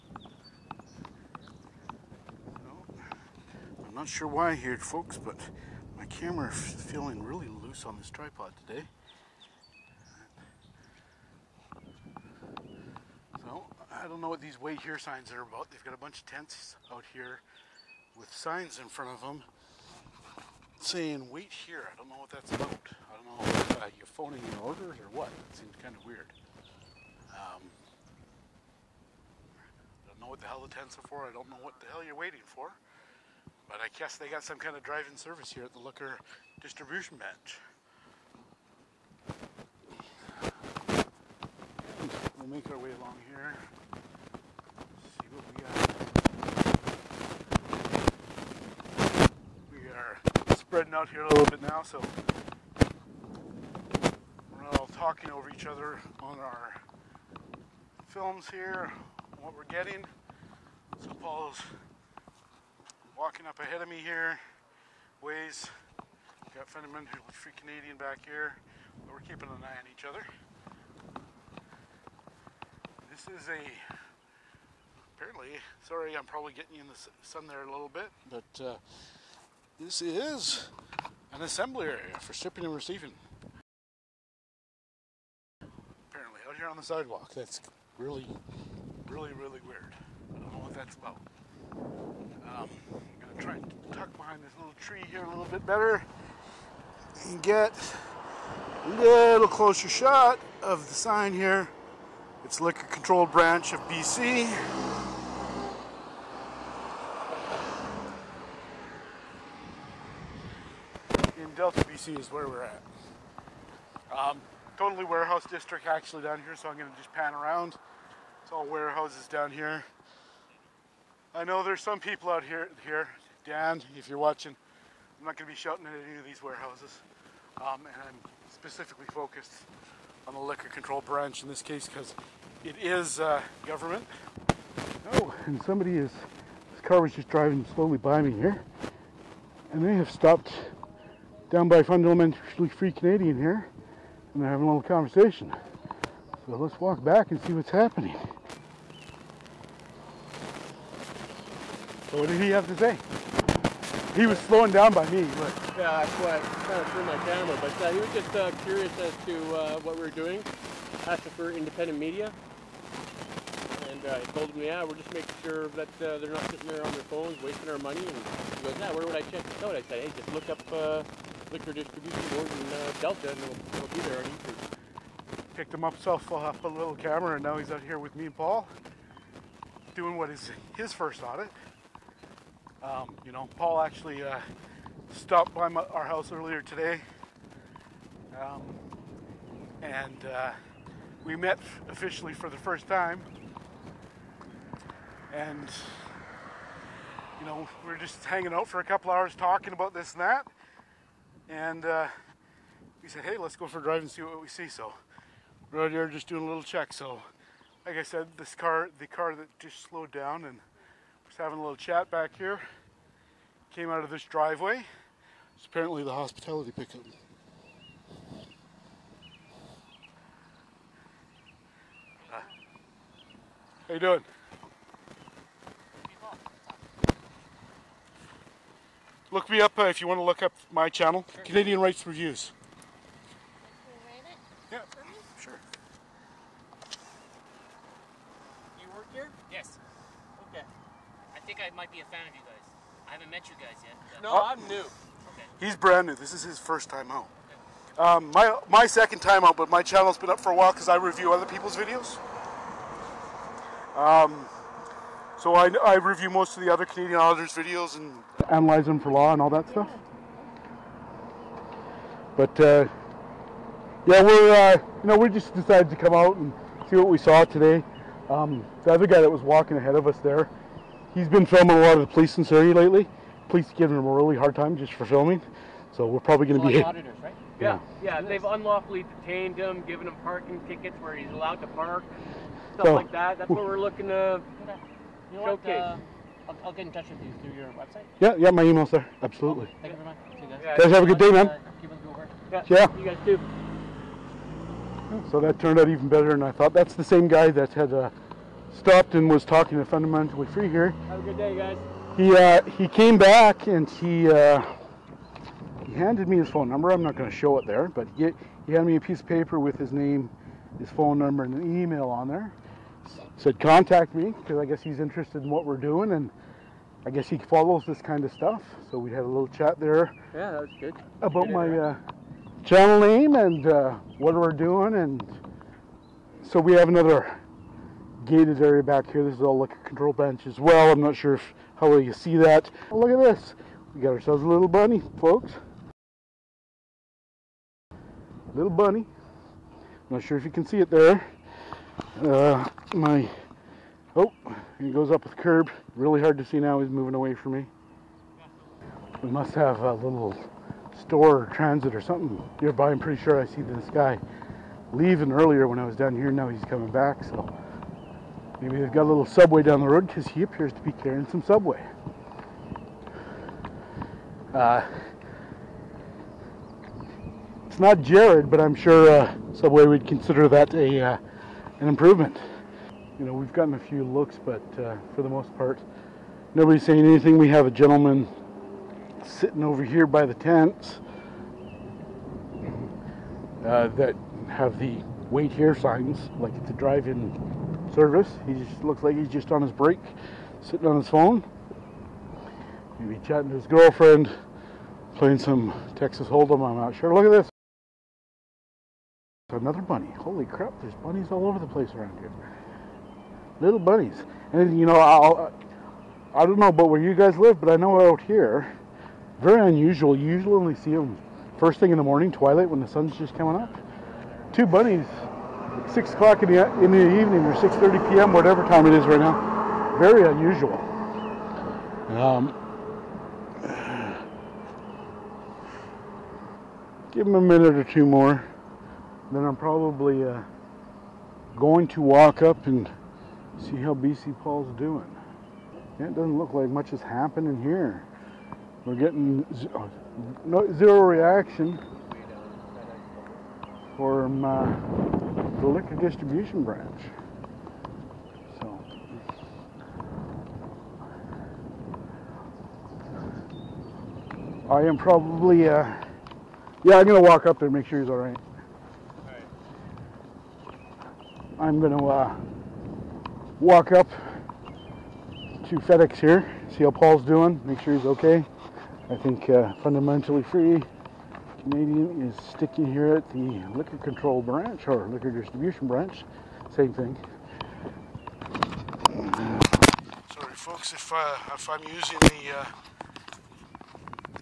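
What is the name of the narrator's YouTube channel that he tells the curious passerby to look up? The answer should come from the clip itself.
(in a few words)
Canadian Rights Reviews.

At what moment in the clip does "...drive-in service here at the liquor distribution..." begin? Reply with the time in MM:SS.
00:34.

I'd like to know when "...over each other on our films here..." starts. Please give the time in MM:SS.
00:55.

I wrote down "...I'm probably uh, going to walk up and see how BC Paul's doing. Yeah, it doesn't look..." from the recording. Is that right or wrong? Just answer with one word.
right.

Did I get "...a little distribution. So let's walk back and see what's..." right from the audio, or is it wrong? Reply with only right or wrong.
wrong.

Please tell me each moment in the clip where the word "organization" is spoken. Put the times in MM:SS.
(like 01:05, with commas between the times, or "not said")
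not said.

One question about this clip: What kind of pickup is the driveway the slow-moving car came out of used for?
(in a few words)
Hospitality pickup.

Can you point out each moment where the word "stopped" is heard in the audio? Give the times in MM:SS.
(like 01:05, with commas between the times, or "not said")
02:20, 03:05, 04:58.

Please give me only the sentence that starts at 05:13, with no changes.
Said contact me because I guess he's interested in what we're doing and.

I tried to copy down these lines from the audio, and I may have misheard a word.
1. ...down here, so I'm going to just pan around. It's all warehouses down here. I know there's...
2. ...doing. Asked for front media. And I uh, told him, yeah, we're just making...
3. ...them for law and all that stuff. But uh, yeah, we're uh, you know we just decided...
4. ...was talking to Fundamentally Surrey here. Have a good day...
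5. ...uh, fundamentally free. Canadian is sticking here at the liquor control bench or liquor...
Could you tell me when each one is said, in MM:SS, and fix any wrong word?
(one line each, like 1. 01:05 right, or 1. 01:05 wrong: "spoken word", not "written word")
1. 01:56 right
2. 02:40 wrong: "independent", not "front"
3. 04:18 right
4. 04:59 wrong: "Free", not "Surrey"
5. 07:49 wrong: "branch", not "bench".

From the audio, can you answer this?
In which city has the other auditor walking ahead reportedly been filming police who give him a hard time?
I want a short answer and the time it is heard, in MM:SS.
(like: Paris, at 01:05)
Surrey, at 04:32.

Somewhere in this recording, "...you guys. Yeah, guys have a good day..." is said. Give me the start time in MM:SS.
04:50.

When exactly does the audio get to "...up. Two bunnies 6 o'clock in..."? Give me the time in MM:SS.
06:53.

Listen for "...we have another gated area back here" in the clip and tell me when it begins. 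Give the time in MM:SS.
05:26.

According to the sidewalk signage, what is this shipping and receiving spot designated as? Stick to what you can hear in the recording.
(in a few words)
Assembly area.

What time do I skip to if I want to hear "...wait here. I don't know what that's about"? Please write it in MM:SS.
00:21.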